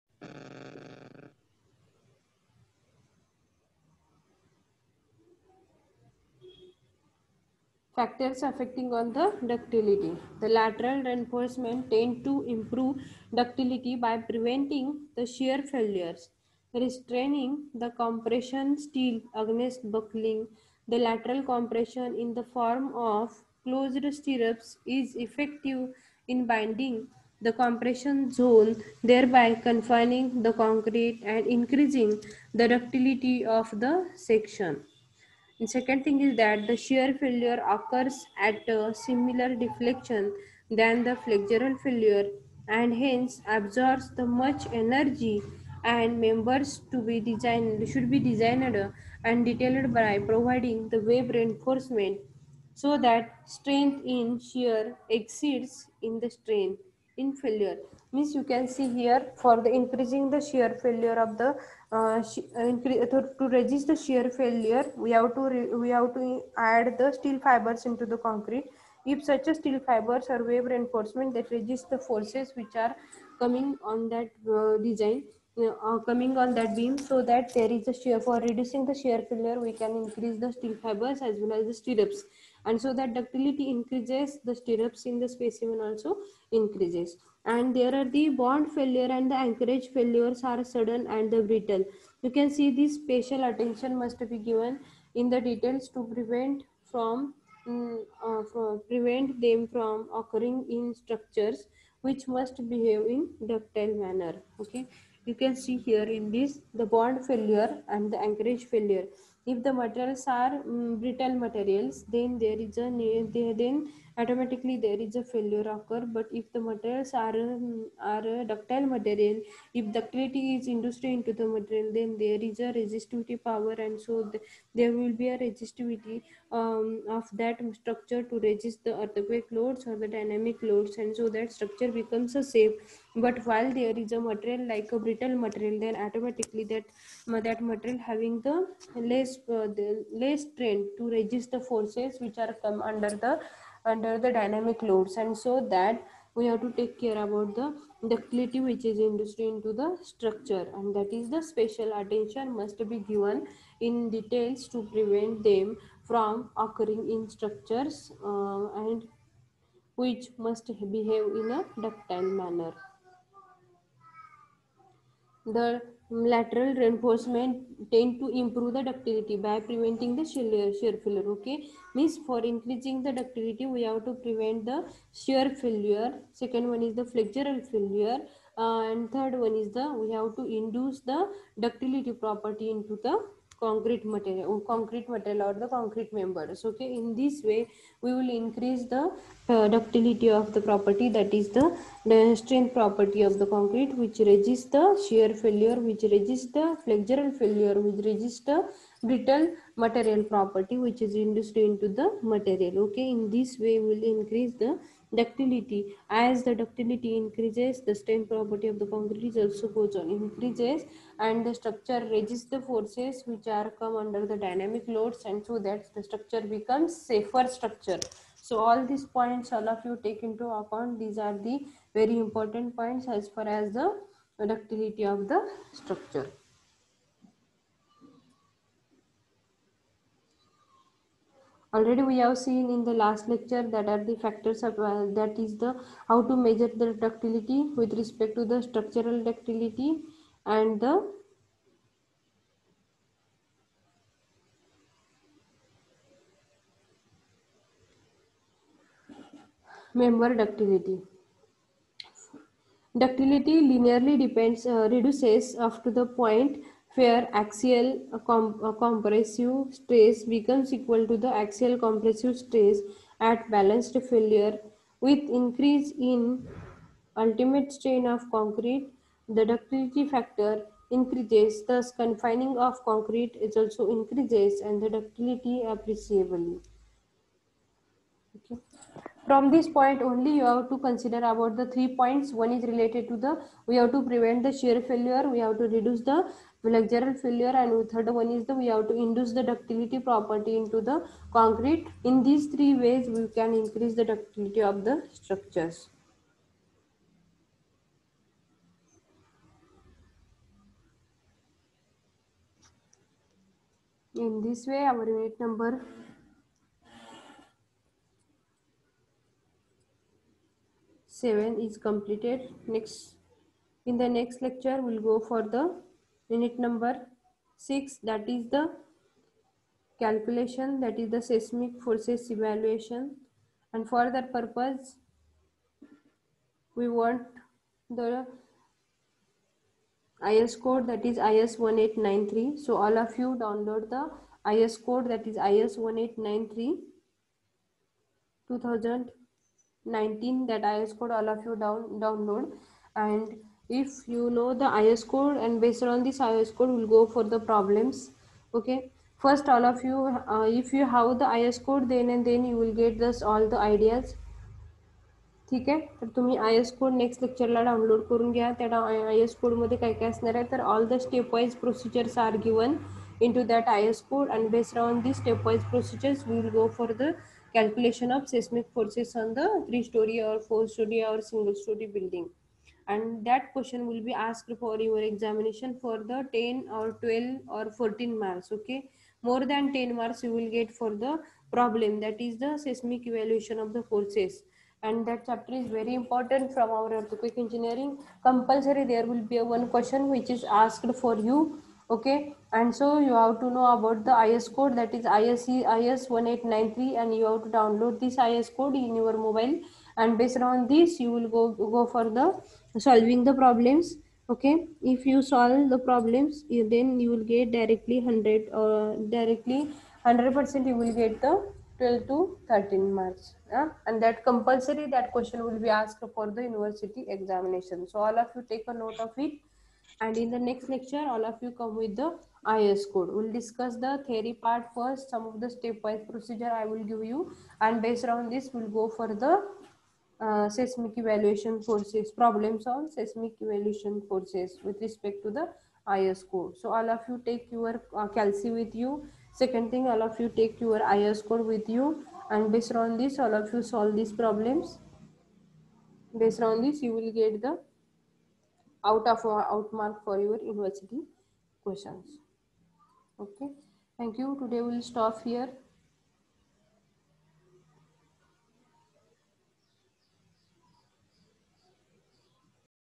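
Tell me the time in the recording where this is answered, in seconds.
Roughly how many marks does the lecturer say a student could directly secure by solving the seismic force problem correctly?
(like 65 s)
411 s.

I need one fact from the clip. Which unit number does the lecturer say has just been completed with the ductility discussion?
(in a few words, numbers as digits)
7.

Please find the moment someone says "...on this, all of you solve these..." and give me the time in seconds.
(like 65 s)
442 s.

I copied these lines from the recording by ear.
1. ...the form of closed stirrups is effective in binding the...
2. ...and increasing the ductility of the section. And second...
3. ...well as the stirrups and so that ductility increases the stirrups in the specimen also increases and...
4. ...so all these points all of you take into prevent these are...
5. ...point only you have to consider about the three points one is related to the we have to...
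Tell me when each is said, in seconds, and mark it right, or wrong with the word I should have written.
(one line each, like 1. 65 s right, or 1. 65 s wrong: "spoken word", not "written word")
1. 22 s right
2. 31 s right
3. 81 s right
4. 218 s wrong: "account", not "prevent"
5. 279 s right.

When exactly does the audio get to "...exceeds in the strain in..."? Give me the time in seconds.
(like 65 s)
55 s.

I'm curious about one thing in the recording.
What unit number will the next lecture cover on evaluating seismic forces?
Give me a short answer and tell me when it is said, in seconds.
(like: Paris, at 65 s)
6, at 316 s.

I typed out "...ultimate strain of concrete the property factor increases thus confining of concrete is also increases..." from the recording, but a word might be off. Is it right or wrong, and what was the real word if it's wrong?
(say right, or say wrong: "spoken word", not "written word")
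wrong: "ductility", not "property".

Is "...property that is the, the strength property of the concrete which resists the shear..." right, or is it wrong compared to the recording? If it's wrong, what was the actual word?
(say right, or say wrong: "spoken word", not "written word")
right.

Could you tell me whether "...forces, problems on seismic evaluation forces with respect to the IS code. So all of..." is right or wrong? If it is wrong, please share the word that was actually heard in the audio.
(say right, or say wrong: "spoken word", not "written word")
right.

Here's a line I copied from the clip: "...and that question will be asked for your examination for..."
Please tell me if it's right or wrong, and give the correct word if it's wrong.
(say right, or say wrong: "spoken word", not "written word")
right.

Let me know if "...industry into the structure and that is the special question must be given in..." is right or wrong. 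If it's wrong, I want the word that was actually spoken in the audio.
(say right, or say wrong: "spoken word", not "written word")
wrong: "attention", not "question".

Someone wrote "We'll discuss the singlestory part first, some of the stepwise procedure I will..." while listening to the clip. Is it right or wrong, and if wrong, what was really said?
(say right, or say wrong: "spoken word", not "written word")
wrong: "theory", not "singlestory".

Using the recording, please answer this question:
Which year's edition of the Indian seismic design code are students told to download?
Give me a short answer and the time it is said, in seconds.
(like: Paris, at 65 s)
2019, at 338 s.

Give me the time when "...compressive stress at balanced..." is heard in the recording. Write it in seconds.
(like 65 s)
261 s.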